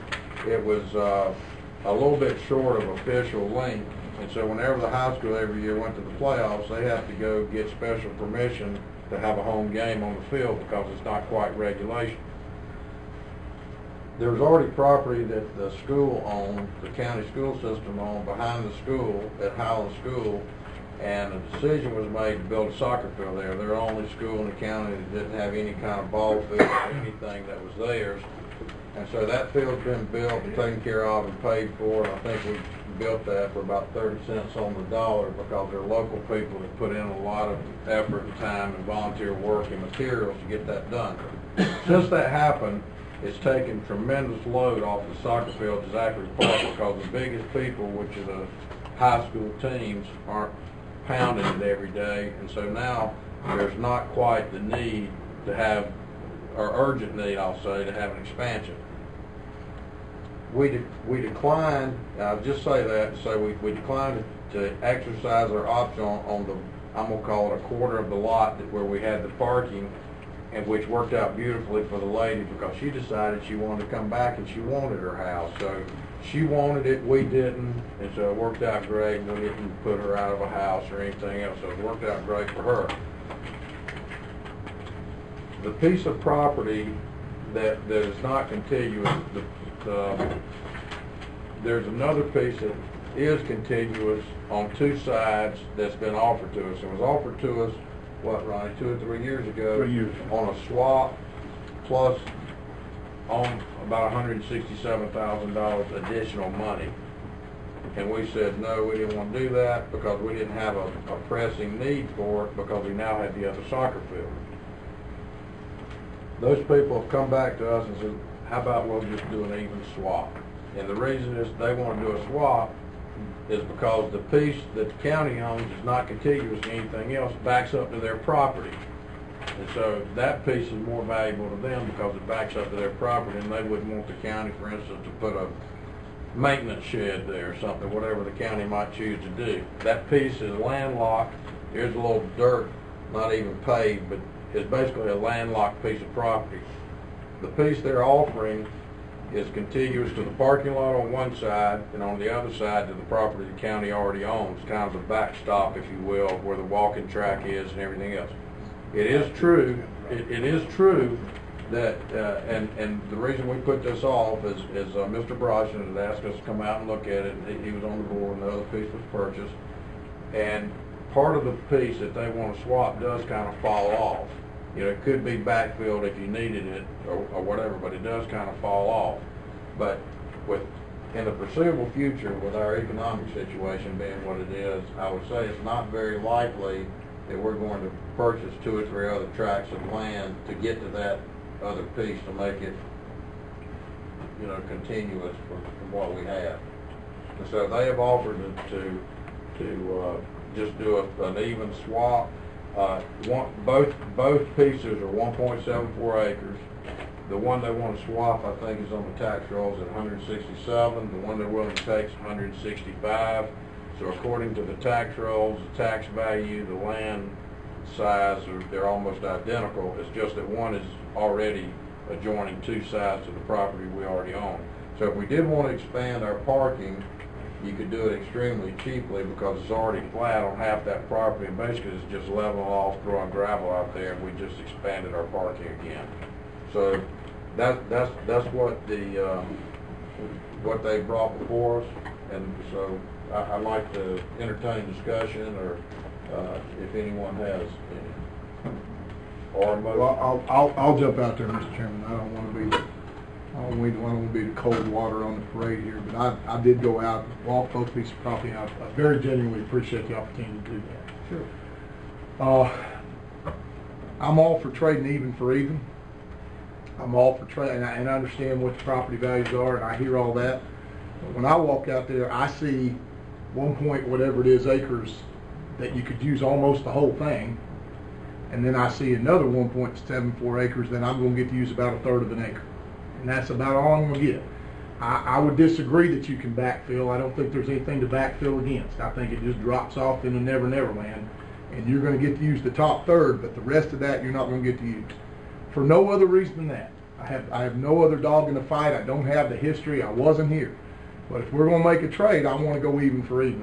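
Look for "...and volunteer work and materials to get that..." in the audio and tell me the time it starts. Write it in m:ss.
0:38.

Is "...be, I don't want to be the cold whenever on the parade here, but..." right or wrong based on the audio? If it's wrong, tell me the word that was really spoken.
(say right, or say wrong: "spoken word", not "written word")
wrong: "water", not "whenever".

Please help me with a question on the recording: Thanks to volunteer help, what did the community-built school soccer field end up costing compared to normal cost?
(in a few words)
30 cents on the dollar.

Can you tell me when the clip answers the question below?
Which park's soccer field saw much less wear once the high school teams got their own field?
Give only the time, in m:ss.
0:45.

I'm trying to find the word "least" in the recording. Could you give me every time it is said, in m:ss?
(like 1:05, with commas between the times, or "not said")
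not said.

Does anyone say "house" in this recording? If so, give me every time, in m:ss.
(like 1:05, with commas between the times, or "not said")
1:15, 1:20.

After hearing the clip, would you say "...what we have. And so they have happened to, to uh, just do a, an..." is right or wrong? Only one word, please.
wrong.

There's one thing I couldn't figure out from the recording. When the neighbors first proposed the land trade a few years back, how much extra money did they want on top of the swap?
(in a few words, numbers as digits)
$167,000.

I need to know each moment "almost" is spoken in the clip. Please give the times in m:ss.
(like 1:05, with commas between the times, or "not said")
3:38, 4:36.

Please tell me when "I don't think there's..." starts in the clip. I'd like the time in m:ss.
4:47.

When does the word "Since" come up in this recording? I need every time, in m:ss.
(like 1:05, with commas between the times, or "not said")
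0:41.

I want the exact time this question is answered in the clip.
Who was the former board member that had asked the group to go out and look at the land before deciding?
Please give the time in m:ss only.
2:45.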